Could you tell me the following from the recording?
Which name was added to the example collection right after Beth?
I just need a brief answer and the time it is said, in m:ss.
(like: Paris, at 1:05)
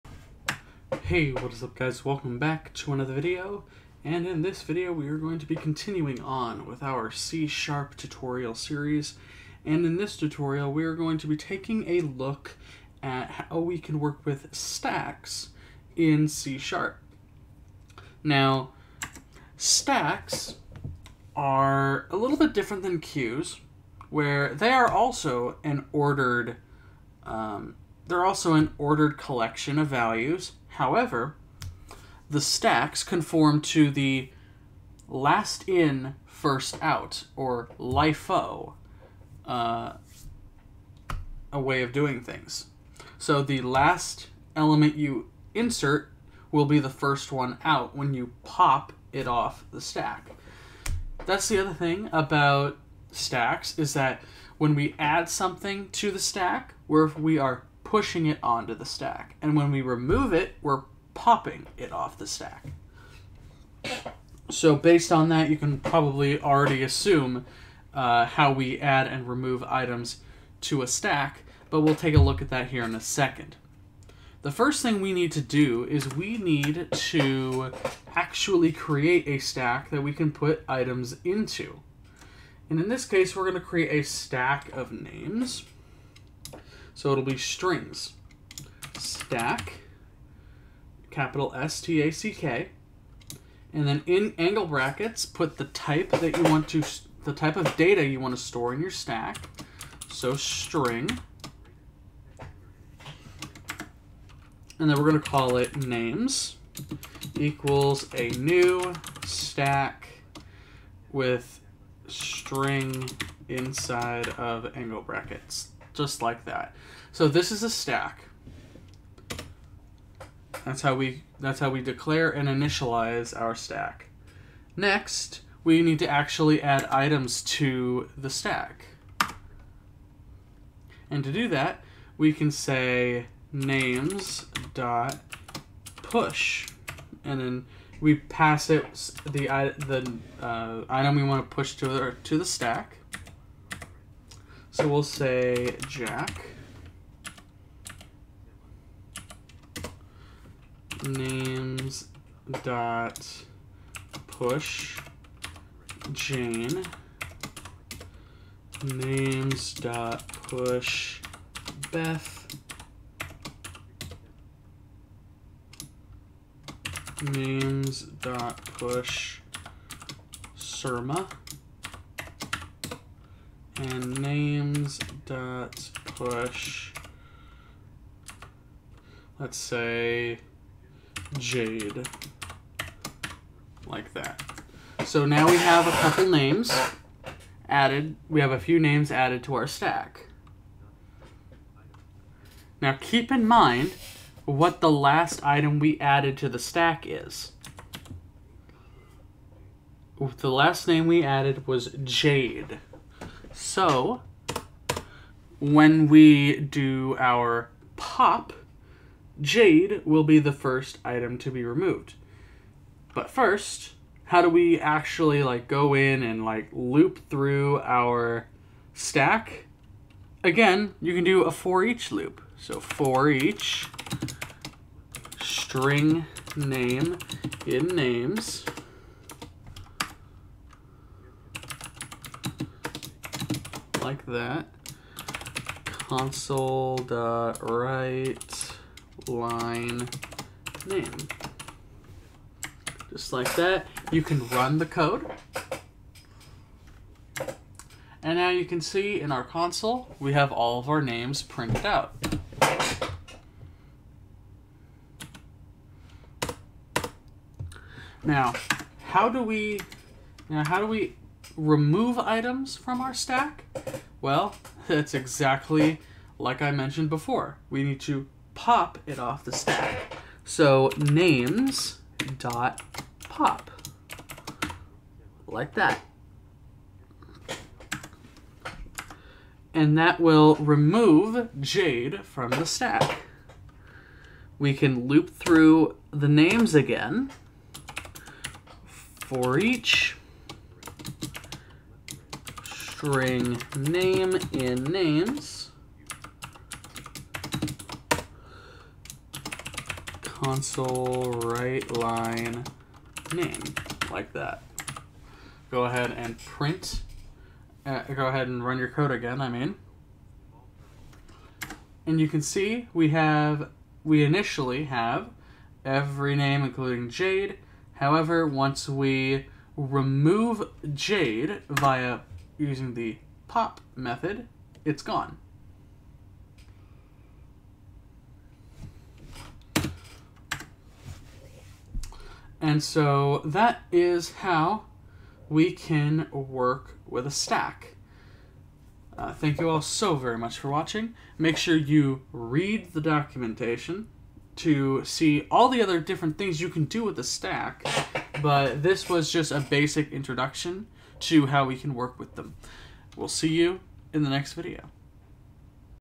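Surma, at 2:50.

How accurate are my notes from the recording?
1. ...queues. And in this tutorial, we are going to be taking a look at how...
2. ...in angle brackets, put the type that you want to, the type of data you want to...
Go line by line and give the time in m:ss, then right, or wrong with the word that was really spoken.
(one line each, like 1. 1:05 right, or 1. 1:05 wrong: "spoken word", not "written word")
1. 0:08 wrong: "series", not "queues"
2. 1:34 right.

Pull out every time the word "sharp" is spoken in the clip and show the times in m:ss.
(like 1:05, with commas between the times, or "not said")
0:07, 0:16.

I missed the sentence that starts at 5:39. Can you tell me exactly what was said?
Uh, thank you all so very much for watching.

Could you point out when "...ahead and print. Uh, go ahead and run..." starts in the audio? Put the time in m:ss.
5:05.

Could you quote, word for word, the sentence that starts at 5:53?
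We'll see you in the next video.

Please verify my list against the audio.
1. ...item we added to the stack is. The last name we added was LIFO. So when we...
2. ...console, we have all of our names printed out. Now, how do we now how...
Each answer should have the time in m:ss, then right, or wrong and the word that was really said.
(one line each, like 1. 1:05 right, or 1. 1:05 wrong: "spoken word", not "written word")
1. 3:15 wrong: "Jade", not "LIFO"
2. 4:09 right.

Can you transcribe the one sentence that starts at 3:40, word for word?
Again, you can do a for each loop.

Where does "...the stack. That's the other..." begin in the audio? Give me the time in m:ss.
0:49.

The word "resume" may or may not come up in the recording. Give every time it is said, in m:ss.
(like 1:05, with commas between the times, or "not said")
not said.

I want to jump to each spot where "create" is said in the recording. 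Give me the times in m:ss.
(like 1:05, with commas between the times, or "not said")
1:18, 1:23.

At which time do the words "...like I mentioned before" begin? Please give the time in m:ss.
4:26.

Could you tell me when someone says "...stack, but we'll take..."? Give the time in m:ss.
1:10.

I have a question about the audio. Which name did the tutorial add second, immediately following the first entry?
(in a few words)
Jane.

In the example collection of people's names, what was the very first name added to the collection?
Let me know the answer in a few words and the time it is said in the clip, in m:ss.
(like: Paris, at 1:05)
Jack, at 2:25.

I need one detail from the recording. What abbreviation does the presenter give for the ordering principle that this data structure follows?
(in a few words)
LIFO.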